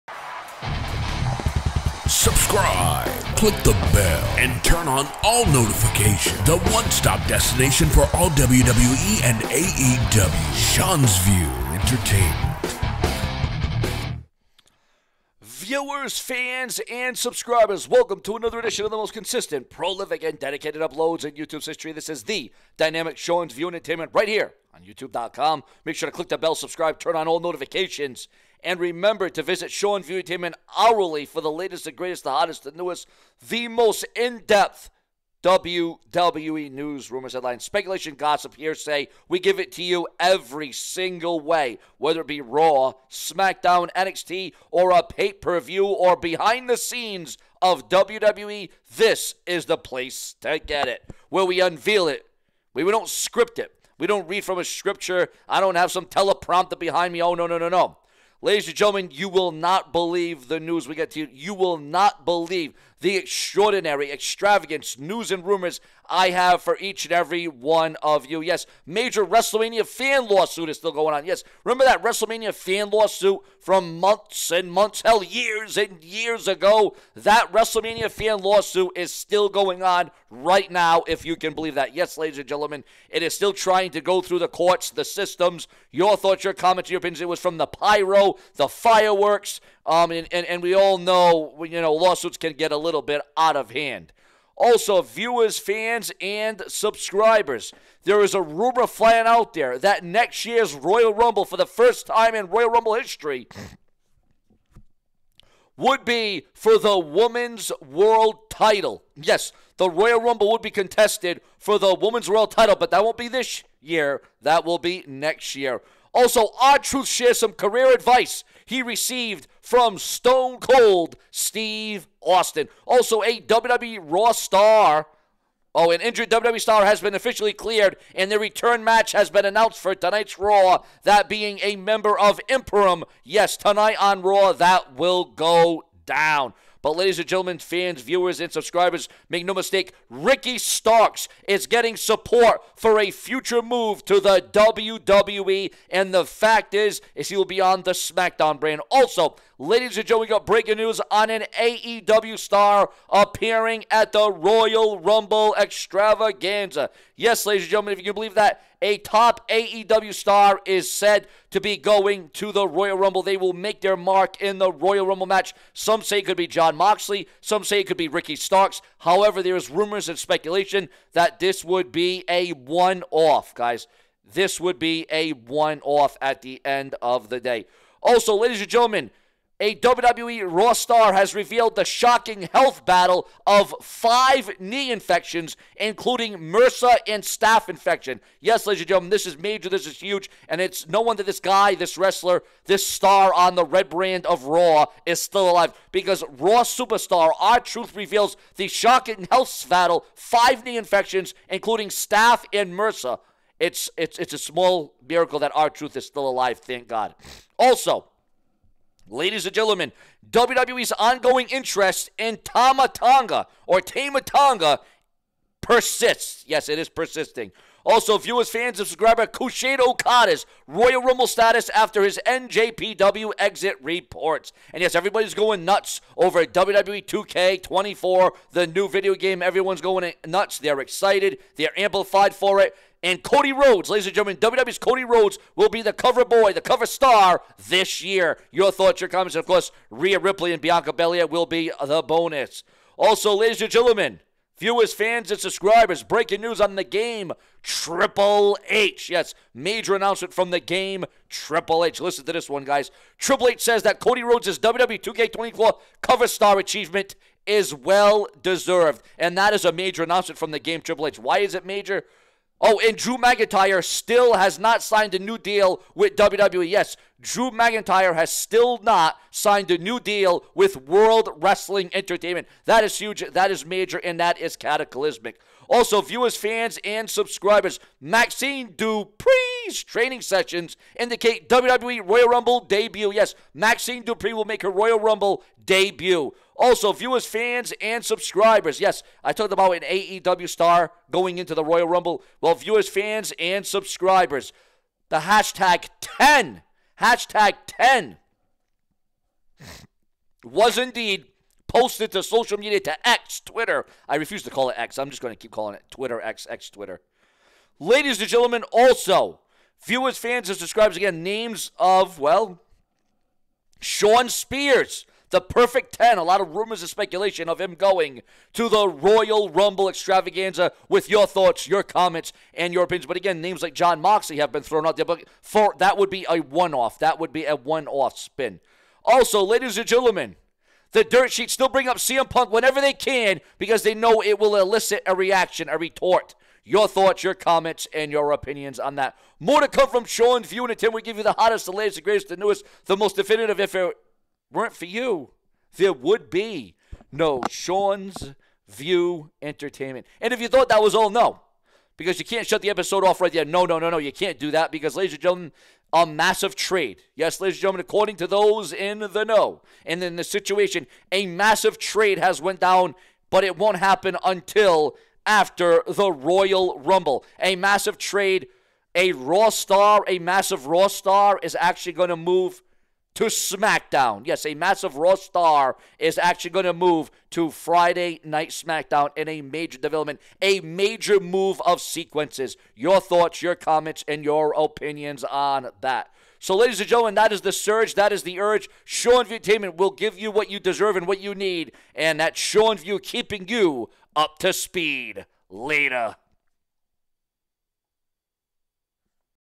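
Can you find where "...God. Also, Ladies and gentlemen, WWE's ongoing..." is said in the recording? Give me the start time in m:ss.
3:26.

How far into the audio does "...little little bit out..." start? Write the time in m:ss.
1:32.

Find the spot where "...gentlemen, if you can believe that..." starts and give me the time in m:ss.
2:37.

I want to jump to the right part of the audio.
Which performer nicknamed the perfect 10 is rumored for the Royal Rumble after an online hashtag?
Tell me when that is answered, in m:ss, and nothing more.
5:13.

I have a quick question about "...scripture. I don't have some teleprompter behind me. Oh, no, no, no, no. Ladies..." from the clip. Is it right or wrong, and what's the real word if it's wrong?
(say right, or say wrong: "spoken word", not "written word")
right.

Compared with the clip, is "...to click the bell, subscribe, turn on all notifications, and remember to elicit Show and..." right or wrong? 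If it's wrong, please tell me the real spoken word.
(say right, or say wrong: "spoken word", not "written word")
wrong: "visit", not "elicit".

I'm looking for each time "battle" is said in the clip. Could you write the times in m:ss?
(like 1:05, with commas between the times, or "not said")
3:02, 3:19.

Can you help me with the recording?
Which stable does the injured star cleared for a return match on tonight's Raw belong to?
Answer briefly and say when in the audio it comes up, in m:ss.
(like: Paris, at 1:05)
Imperium, at 2:12.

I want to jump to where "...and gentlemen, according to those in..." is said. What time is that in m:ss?
5:57.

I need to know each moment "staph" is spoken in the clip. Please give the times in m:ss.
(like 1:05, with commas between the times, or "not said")
3:07, 3:21.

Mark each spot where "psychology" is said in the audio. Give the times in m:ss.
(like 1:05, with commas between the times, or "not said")
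not said.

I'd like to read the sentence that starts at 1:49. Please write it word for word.
Yes, the Royal Rumble would be contested for the Women's World title, but that won't be this year.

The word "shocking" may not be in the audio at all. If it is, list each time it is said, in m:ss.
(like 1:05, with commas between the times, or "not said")
3:01, 3:18.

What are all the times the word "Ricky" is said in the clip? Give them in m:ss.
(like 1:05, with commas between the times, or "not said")
2:20, 2:48.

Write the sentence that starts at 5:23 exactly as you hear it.
But again, names like Jon Moxley have been thrown out there, but for, that would be a one off.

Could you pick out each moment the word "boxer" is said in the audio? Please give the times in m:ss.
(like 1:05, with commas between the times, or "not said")
not said.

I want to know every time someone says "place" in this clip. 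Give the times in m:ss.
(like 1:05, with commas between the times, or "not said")
0:49.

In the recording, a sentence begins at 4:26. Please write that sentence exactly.
Yes, Drew McIntyre has still not signed a new deal with World Wrestling Entertainment.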